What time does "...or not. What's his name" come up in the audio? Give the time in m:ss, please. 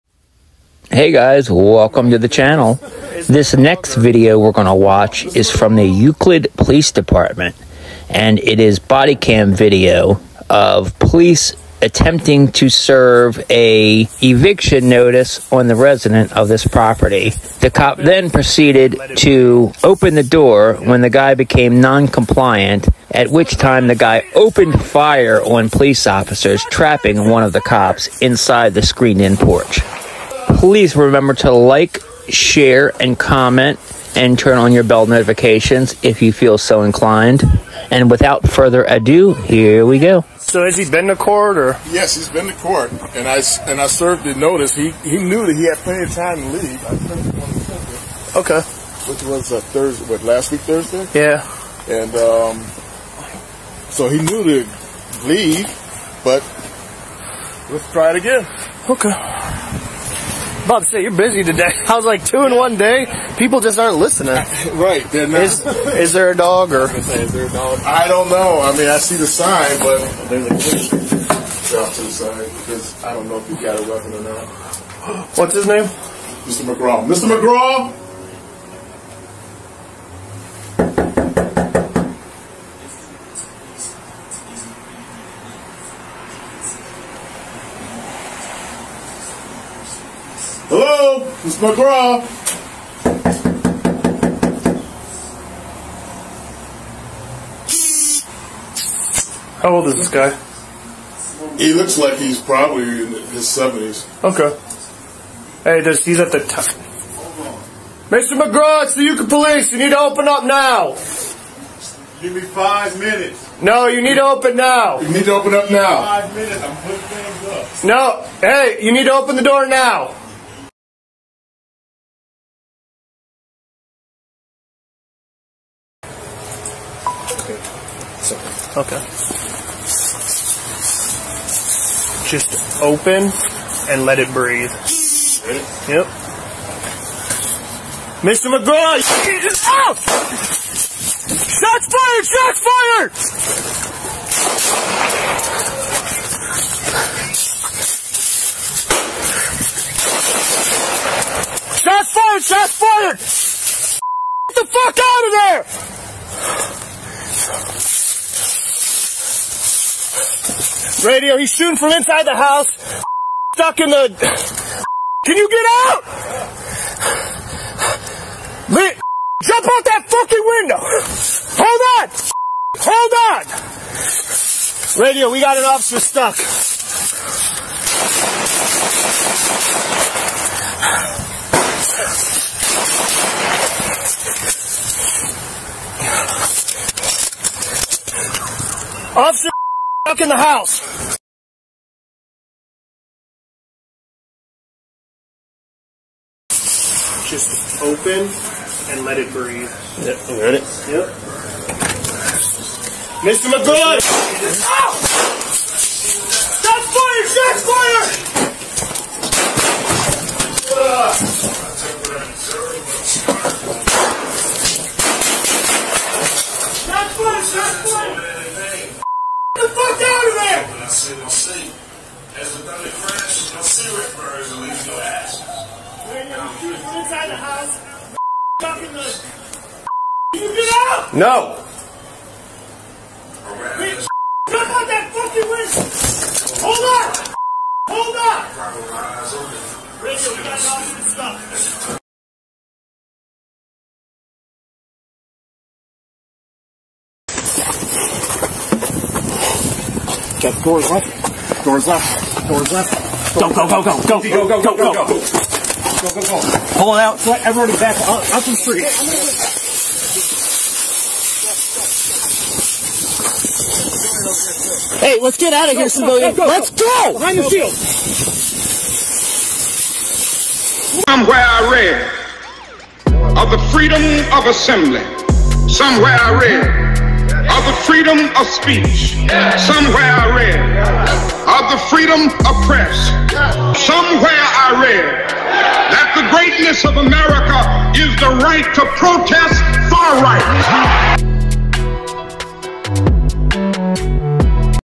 1:14.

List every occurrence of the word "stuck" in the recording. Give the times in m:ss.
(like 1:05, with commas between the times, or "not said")
2:43, 2:55, 3:10.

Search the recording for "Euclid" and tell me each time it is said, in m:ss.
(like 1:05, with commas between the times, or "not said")
0:05, 1:49.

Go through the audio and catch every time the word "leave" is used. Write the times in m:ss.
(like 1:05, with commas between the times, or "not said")
0:46, 0:55.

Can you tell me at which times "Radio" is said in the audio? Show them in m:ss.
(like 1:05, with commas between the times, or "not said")
2:41, 2:55.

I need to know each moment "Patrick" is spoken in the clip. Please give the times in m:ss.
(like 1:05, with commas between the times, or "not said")
not said.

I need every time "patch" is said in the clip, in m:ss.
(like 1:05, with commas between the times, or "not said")
not said.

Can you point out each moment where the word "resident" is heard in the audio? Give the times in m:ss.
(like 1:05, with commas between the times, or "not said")
0:15.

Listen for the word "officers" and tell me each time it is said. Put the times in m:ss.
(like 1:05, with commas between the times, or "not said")
0:26, 2:55, 3:09.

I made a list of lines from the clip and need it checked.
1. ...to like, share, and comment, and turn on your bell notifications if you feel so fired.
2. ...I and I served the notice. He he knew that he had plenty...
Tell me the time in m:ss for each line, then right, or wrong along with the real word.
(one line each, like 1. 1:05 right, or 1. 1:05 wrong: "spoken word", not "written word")
1. 0:31 wrong: "inclined", not "fired"
2. 0:43 right.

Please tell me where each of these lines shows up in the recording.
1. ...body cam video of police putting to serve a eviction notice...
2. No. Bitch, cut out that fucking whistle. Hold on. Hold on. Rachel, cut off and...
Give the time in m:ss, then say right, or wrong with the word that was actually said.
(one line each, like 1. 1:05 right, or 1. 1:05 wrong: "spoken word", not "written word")
1. 0:08 wrong: "attempting", not "putting"
2. 3:51 right.